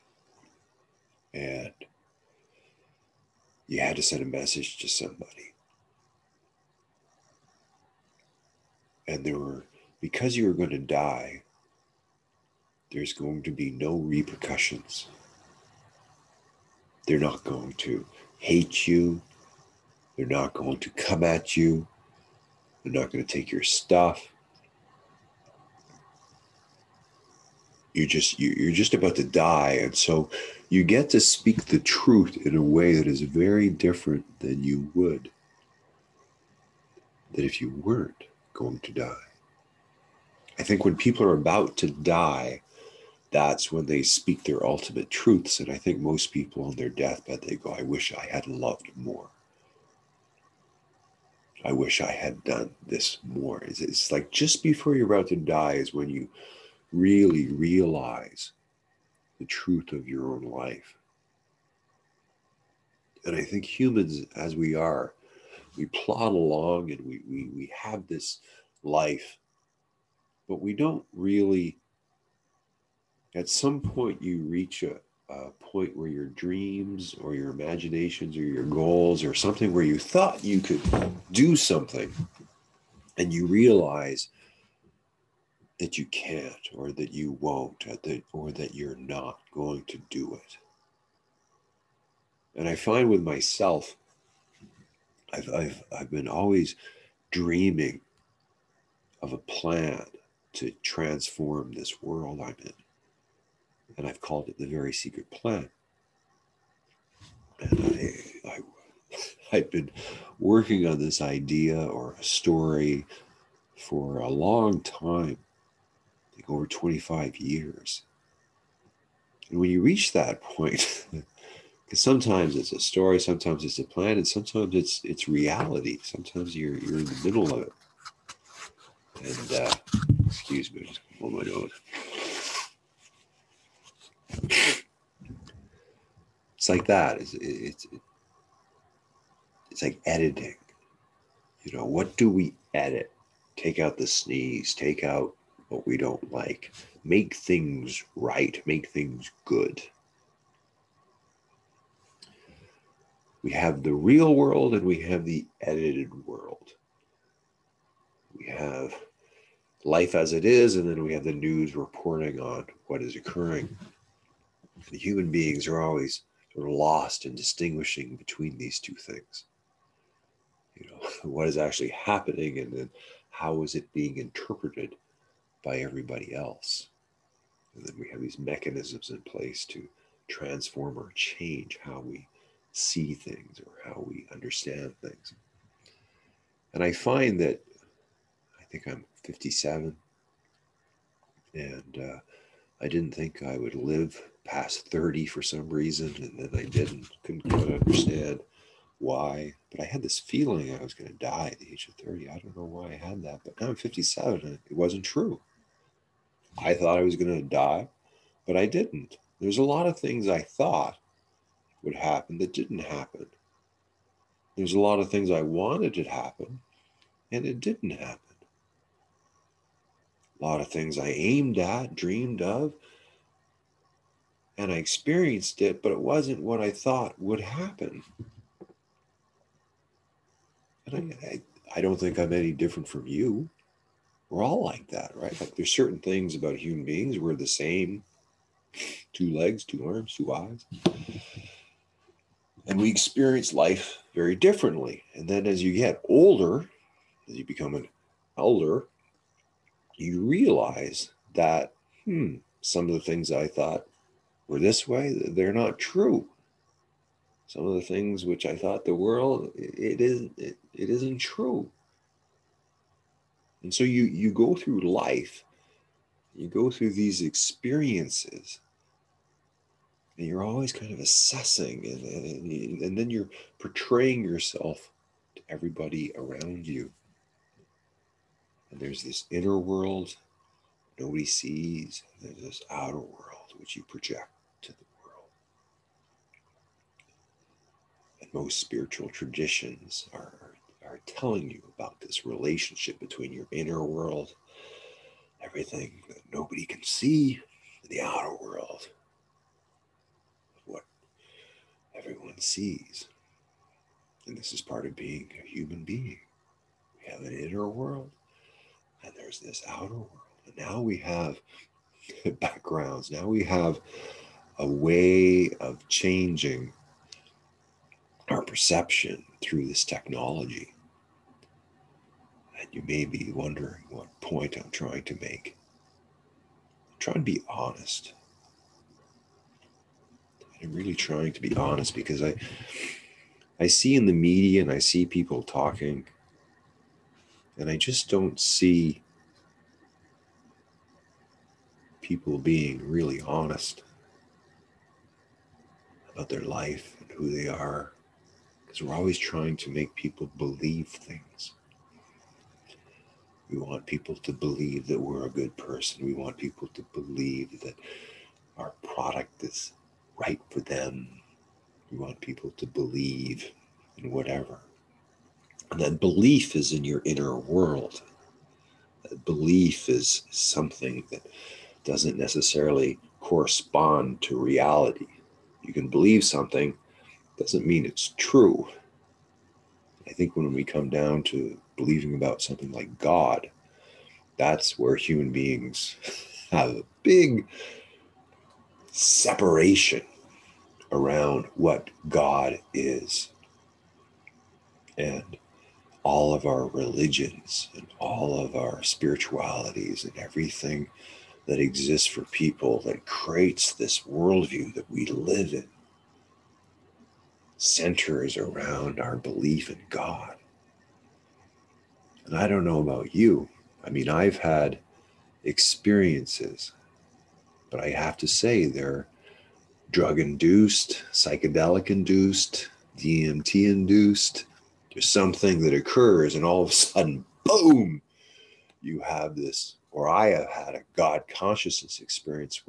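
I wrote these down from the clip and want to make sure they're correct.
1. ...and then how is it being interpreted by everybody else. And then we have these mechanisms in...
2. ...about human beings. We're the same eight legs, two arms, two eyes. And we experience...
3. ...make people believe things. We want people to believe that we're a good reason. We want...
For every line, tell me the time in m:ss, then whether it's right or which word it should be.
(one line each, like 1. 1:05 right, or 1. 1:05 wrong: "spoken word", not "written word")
1. 2:52 right
2. 3:56 wrong: "two", not "eight"
3. 5:49 wrong: "person", not "reason".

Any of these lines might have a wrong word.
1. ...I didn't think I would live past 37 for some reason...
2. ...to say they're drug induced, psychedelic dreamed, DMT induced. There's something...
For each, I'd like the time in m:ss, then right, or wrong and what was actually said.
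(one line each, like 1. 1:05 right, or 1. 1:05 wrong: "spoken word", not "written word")
1. 3:12 wrong: "30", not "37"
2. 6:58 wrong: "induced", not "dreamed".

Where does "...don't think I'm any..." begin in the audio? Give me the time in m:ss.
3:51.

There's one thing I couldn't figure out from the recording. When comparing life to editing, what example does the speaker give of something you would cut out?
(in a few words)
The sneeze.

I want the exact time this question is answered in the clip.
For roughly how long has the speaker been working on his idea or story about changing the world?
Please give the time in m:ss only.
1:56.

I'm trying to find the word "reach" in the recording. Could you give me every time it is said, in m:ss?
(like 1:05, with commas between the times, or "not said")
1:14, 1:59.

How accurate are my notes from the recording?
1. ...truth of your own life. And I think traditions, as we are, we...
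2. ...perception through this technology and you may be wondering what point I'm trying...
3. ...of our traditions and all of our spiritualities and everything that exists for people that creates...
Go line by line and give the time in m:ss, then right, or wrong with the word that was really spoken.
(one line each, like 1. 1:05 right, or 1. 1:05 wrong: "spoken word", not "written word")
1. 0:59 wrong: "humans", not "traditions"
2. 5:18 right
3. 6:36 wrong: "religions", not "traditions".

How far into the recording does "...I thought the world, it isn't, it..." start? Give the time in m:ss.
4:18.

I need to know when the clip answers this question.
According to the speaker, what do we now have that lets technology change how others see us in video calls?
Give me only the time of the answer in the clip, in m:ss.
5:12.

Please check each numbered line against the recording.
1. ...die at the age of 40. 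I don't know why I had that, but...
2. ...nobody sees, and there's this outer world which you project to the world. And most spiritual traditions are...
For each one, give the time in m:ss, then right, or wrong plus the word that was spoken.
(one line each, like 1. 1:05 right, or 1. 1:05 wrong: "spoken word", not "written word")
1. 3:21 wrong: "30", not "40"
2. 4:40 right.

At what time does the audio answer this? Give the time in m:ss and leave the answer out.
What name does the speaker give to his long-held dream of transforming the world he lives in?
1:44.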